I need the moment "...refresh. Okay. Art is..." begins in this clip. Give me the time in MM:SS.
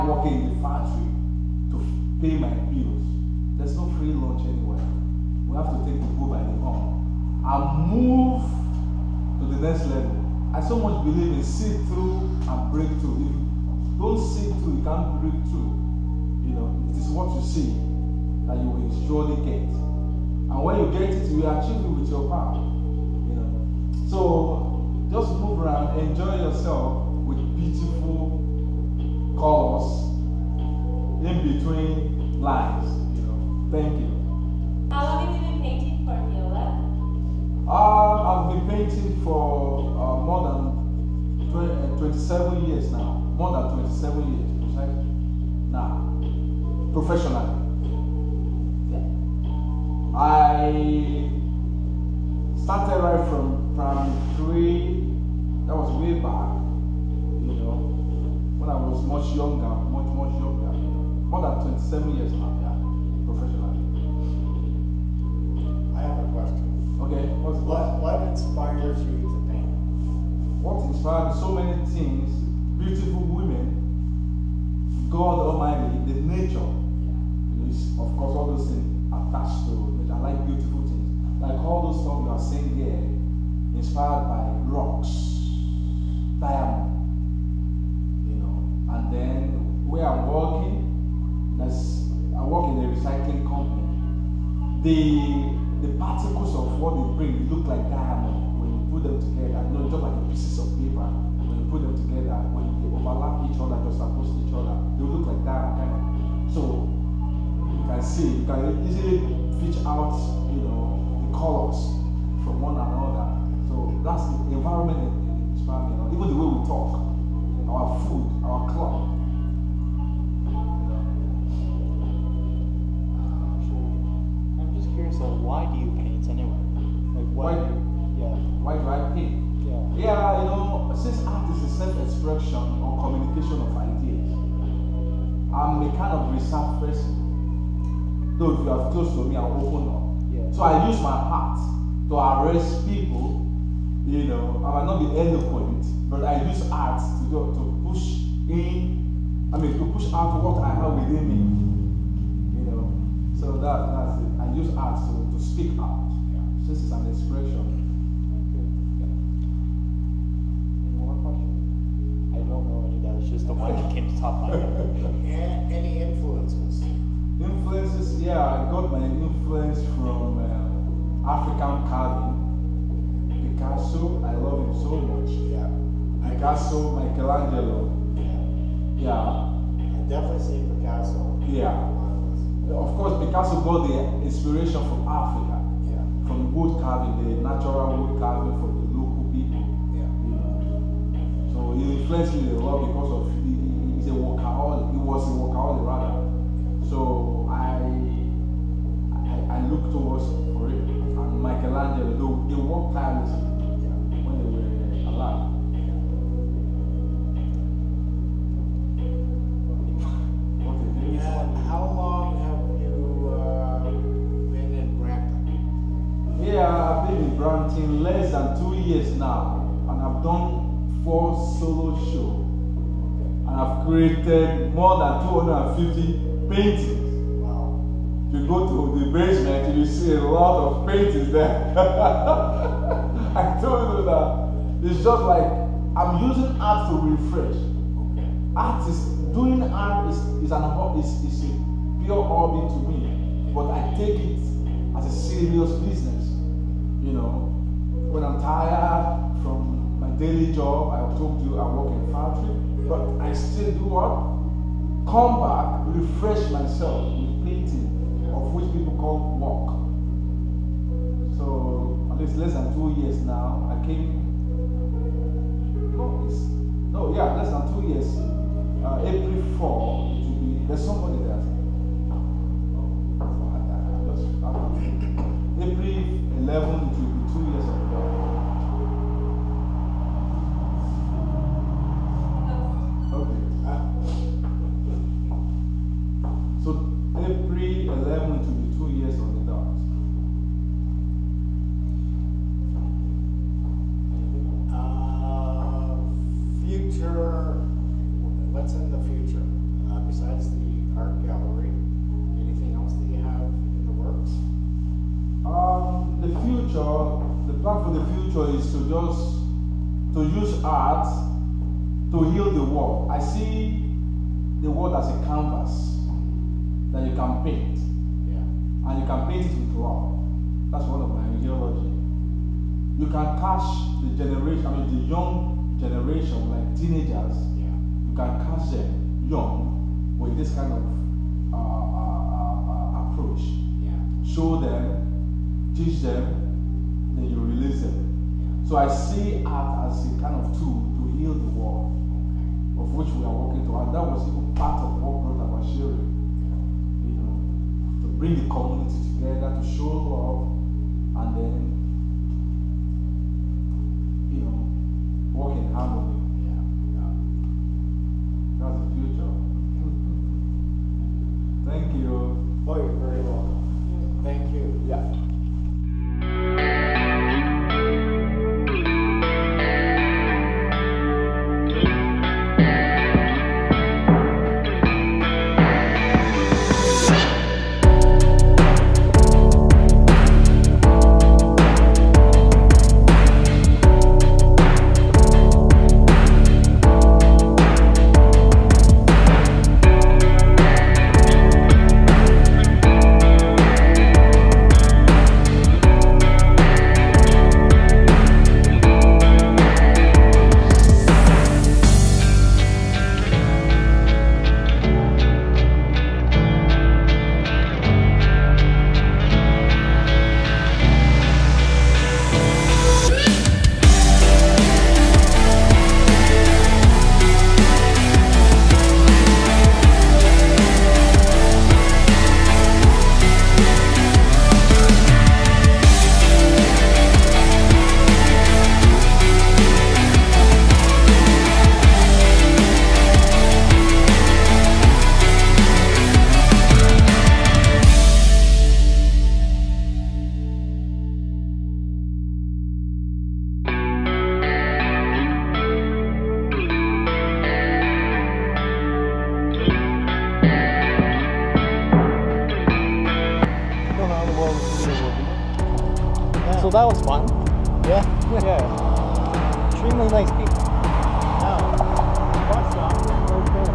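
03:57.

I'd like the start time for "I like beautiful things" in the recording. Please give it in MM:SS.
01:20.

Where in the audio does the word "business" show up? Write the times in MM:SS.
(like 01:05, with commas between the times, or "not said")
04:05.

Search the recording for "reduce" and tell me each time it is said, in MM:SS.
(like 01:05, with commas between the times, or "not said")
not said.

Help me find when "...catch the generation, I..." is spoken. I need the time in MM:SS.
05:23.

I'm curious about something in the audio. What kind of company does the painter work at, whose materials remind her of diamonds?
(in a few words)
recycling company.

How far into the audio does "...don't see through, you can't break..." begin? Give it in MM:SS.
00:13.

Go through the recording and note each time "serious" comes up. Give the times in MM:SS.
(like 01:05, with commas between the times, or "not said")
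04:05.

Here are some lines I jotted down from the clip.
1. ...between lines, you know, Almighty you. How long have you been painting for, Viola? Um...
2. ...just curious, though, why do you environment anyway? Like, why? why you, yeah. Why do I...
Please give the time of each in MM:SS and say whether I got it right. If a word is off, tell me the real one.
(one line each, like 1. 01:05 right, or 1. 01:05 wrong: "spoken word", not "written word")
1. 00:31 wrong: "Thank", not "Almighty"
2. 02:04 wrong: "paint", not "environment".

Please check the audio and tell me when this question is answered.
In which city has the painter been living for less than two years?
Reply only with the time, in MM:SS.
03:37.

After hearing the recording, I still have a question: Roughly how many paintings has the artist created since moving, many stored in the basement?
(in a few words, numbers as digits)
more than 250.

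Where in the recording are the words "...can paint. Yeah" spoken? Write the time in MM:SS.
05:17.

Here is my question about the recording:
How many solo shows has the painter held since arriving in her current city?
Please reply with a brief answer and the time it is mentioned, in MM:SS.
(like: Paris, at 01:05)
4, at 03:41.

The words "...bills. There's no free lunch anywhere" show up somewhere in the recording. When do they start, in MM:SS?
00:02.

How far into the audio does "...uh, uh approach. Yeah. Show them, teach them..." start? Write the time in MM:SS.
05:31.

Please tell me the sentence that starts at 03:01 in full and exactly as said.
Yeah of course, Picasso got the inspiration from Africa, yeah.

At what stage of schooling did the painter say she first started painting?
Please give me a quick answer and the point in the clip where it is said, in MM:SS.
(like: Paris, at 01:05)
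primary three, at 00:53.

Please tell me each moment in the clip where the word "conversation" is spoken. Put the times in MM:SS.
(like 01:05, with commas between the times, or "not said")
not said.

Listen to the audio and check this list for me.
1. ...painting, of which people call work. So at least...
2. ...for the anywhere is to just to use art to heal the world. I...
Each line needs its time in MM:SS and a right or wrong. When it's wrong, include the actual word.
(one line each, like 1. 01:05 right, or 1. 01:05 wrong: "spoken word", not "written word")
1. 04:17 right
2. 05:07 wrong: "future", not "anywhere".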